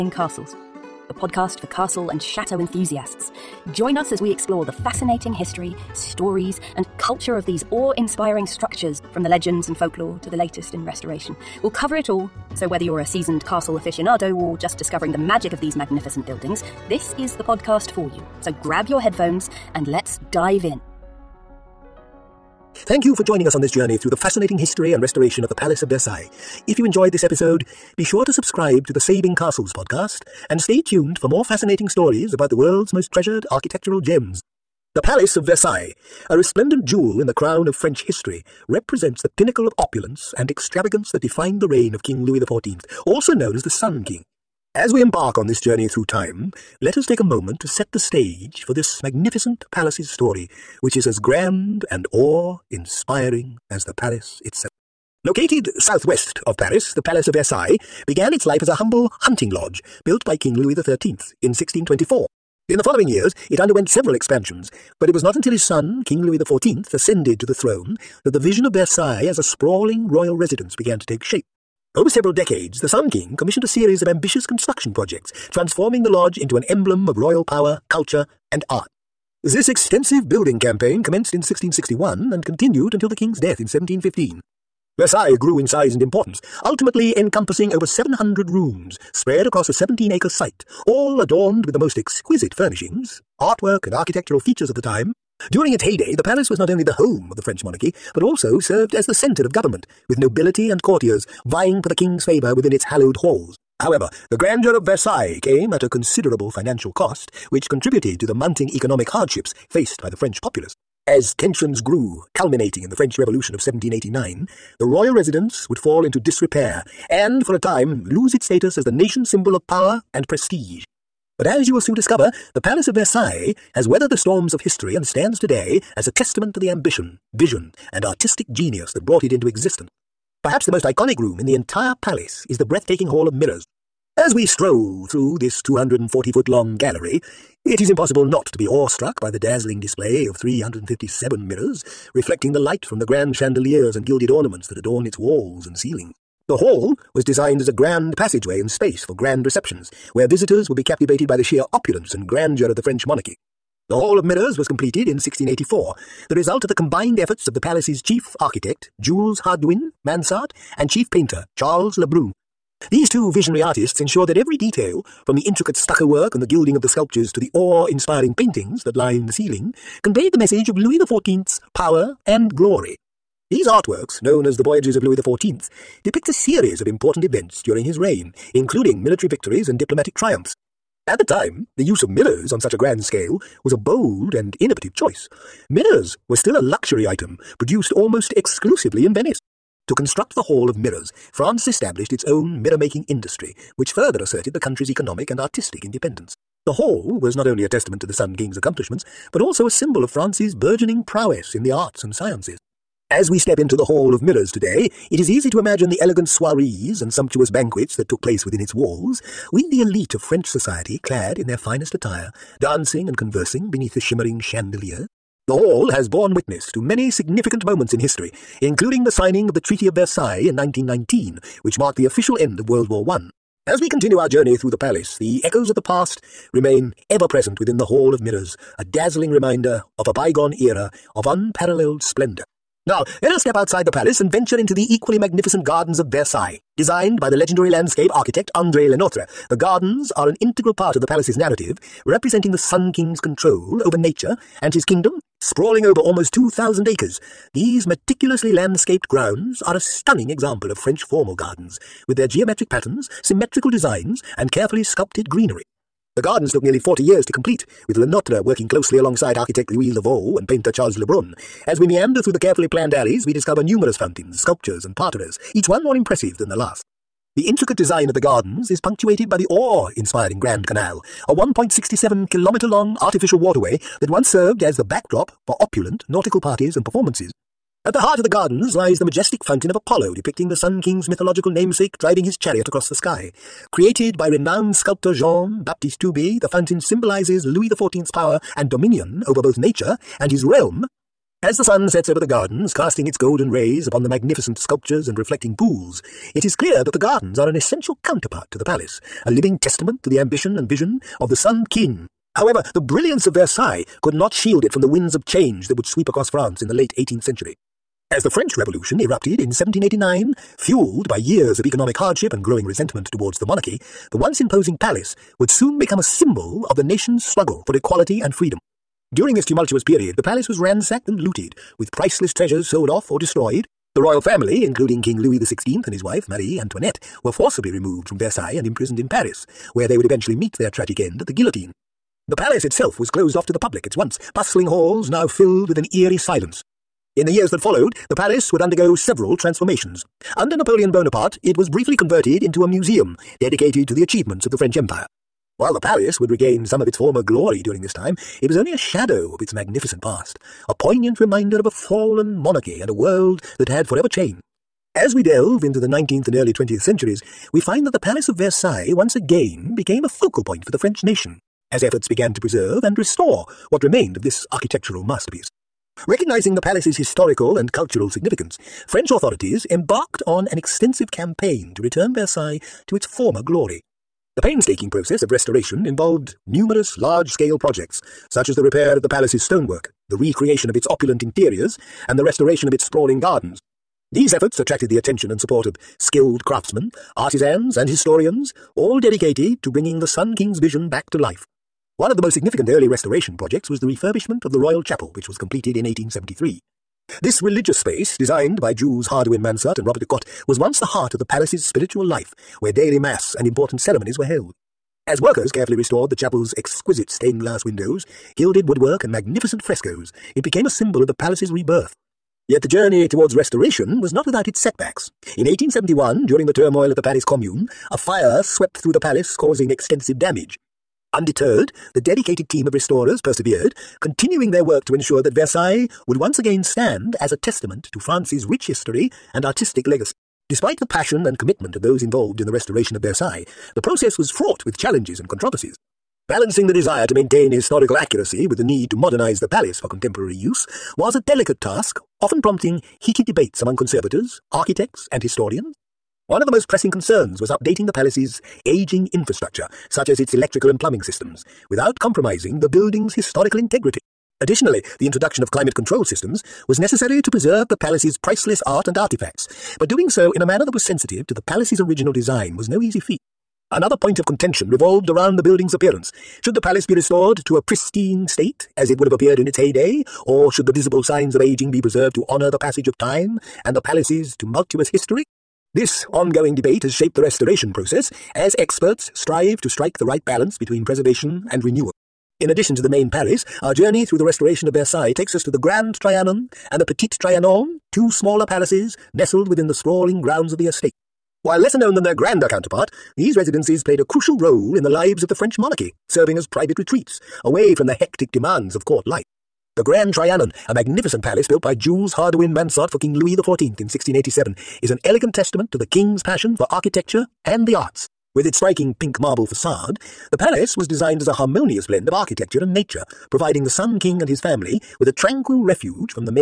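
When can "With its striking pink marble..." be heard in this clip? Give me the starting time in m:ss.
8:28.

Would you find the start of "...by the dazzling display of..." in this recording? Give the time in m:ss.
2:19.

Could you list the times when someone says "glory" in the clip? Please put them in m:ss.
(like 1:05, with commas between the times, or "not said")
2:52, 5:47, 6:13.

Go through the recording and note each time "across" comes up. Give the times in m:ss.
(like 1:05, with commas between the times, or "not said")
1:29, 4:42, 5:06.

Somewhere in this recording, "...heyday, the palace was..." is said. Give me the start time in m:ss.
1:35.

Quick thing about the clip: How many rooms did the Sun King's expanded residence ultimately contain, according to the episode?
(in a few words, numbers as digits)
over 700.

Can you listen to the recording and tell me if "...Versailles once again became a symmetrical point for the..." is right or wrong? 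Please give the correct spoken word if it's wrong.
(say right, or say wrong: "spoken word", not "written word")
wrong: "focal", not "symmetrical".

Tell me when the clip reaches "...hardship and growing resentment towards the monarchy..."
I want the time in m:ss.
5:11.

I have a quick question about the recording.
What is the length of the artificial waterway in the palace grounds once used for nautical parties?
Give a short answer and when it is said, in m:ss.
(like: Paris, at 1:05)
1.67 kilometres, at 4:31.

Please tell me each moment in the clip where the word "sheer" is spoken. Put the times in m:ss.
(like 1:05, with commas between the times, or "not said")
2:31.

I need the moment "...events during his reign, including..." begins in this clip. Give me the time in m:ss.
2:57.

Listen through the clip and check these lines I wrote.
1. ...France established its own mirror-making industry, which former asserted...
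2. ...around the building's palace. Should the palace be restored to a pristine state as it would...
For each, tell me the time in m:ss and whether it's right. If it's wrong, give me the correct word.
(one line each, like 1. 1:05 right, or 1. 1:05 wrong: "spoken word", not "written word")
1. 3:11 wrong: "further", not "former"
2. 7:45 wrong: "appearance", not "palace".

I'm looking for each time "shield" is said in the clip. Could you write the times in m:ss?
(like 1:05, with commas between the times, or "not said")
5:04.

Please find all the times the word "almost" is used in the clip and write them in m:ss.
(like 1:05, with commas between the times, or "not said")
3:07, 4:05.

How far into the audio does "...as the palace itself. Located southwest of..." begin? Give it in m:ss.
0:53.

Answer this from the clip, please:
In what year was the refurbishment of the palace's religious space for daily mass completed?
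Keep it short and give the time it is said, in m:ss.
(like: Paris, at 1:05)
1873, at 6:35.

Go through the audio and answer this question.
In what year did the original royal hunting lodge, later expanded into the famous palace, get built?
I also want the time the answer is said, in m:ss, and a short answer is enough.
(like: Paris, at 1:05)
1624, at 1:01.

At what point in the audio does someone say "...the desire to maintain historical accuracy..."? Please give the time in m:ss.
7:16.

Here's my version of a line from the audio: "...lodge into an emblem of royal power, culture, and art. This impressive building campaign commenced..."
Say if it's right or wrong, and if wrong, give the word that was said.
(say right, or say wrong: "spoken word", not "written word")
wrong: "extensive", not "impressive".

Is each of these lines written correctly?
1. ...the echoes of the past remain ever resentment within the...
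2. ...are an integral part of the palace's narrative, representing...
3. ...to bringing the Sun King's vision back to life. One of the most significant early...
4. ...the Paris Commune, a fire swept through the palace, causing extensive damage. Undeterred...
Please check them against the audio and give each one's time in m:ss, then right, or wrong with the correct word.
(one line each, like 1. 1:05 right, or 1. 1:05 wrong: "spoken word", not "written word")
1. 3:45 wrong: "present", not "resentment"
2. 4:00 right
3. 6:29 right
4. 6:56 right.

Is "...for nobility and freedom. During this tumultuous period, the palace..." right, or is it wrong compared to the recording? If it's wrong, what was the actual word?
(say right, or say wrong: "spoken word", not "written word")
wrong: "equality", not "nobility".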